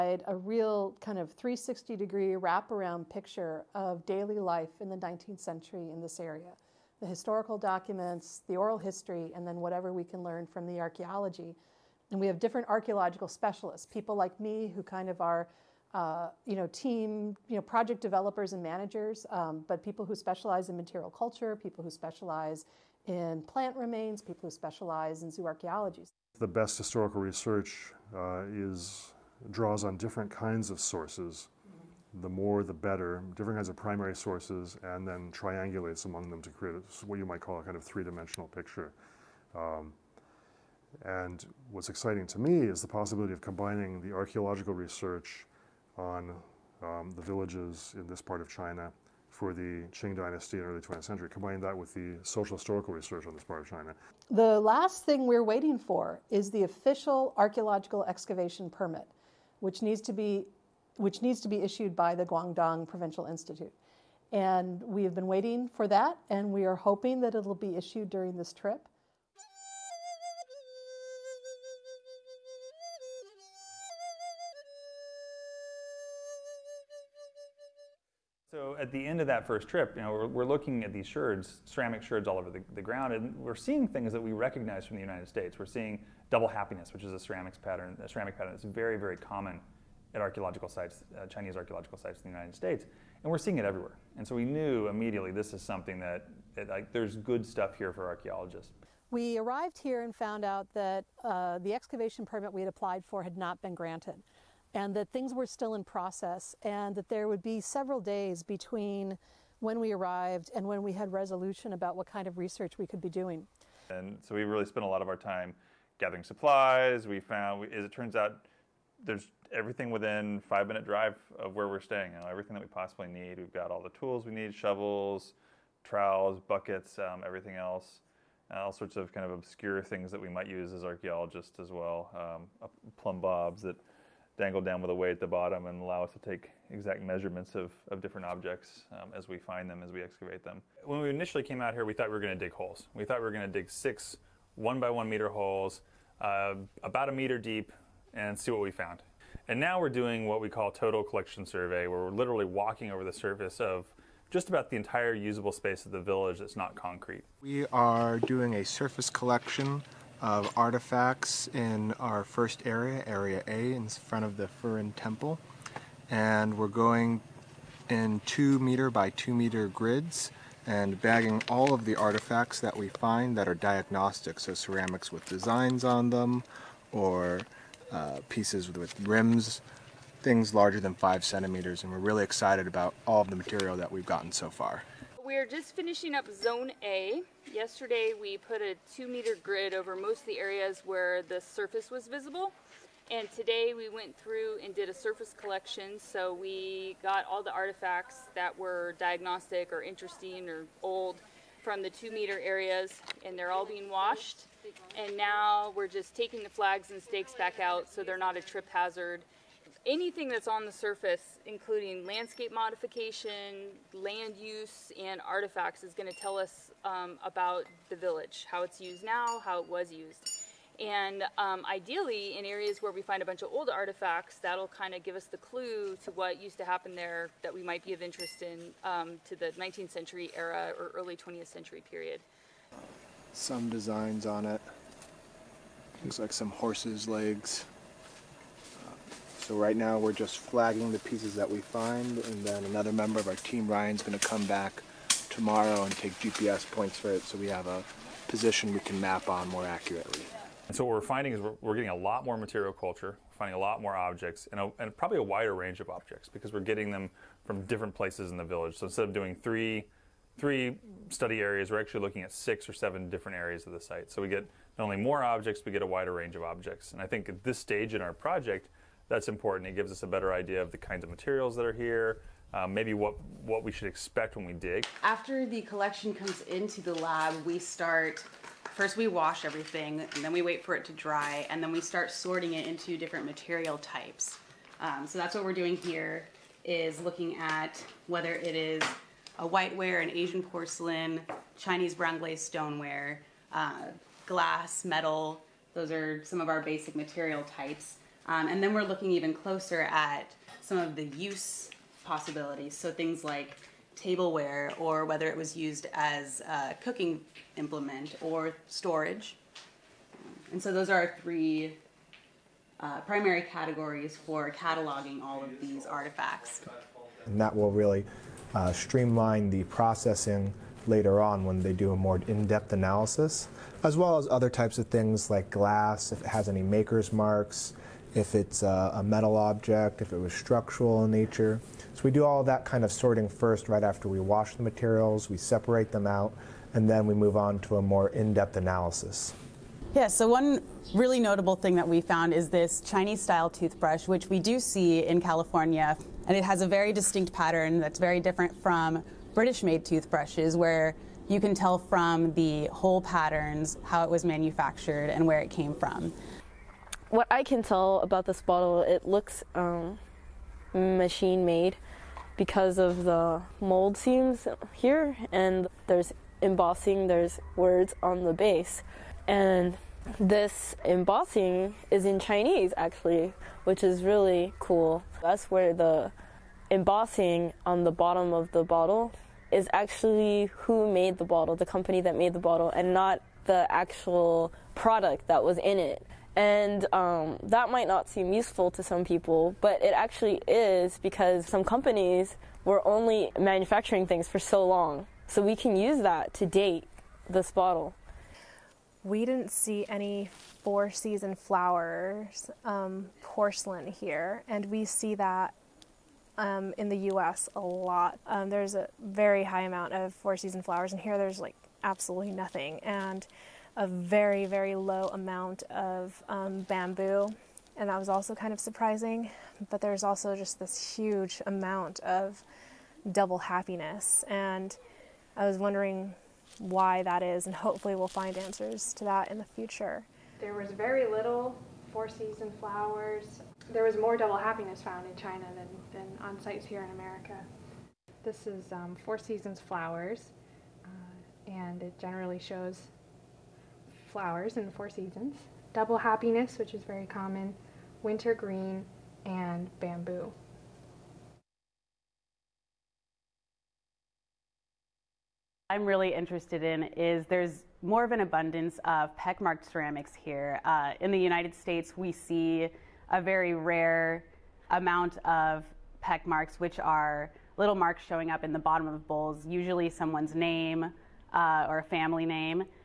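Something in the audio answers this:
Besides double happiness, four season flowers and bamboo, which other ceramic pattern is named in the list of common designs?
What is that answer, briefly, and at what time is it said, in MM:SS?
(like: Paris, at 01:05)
Winter green, at 07:28.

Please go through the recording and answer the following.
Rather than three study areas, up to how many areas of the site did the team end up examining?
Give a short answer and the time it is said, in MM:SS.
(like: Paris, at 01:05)
7, at 04:22.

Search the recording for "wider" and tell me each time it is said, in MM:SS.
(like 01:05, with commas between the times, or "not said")
04:15, 04:25.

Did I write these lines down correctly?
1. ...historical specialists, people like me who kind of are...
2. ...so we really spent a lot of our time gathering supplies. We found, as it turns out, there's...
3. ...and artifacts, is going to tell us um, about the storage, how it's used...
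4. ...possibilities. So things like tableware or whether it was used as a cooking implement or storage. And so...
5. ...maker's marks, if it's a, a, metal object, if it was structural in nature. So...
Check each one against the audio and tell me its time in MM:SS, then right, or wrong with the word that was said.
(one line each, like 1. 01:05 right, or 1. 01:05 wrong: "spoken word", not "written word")
1. 00:12 wrong: "archaeological", not "historical"
2. 01:54 right
3. 03:35 wrong: "village", not "storage"
4. 05:02 right
5. 05:26 right.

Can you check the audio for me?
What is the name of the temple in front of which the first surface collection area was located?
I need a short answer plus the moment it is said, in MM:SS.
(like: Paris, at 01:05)
Furin Temple, at 02:44.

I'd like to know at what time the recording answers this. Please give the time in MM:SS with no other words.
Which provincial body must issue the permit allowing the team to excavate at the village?
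01:02.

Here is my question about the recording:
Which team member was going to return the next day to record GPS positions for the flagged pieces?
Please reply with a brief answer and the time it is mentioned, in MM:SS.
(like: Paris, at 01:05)
Ryan, at 04:03.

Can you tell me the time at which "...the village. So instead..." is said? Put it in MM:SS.
04:18.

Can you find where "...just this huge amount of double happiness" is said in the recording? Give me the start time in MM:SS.
07:00.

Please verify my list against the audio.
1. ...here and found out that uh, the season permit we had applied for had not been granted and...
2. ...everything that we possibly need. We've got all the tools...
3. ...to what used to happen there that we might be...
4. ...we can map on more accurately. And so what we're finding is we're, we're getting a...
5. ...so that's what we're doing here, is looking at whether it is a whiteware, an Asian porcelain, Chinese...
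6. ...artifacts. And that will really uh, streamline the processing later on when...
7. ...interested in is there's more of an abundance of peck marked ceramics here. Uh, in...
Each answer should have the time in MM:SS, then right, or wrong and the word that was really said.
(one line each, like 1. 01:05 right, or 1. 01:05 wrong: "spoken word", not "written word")
1. 01:39 wrong: "excavation", not "season"
2. 02:02 right
3. 03:46 right
4. 04:08 right
5. 04:45 right
6. 05:15 right
7. 07:36 right.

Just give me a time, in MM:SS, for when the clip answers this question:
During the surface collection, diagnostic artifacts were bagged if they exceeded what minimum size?
03:00.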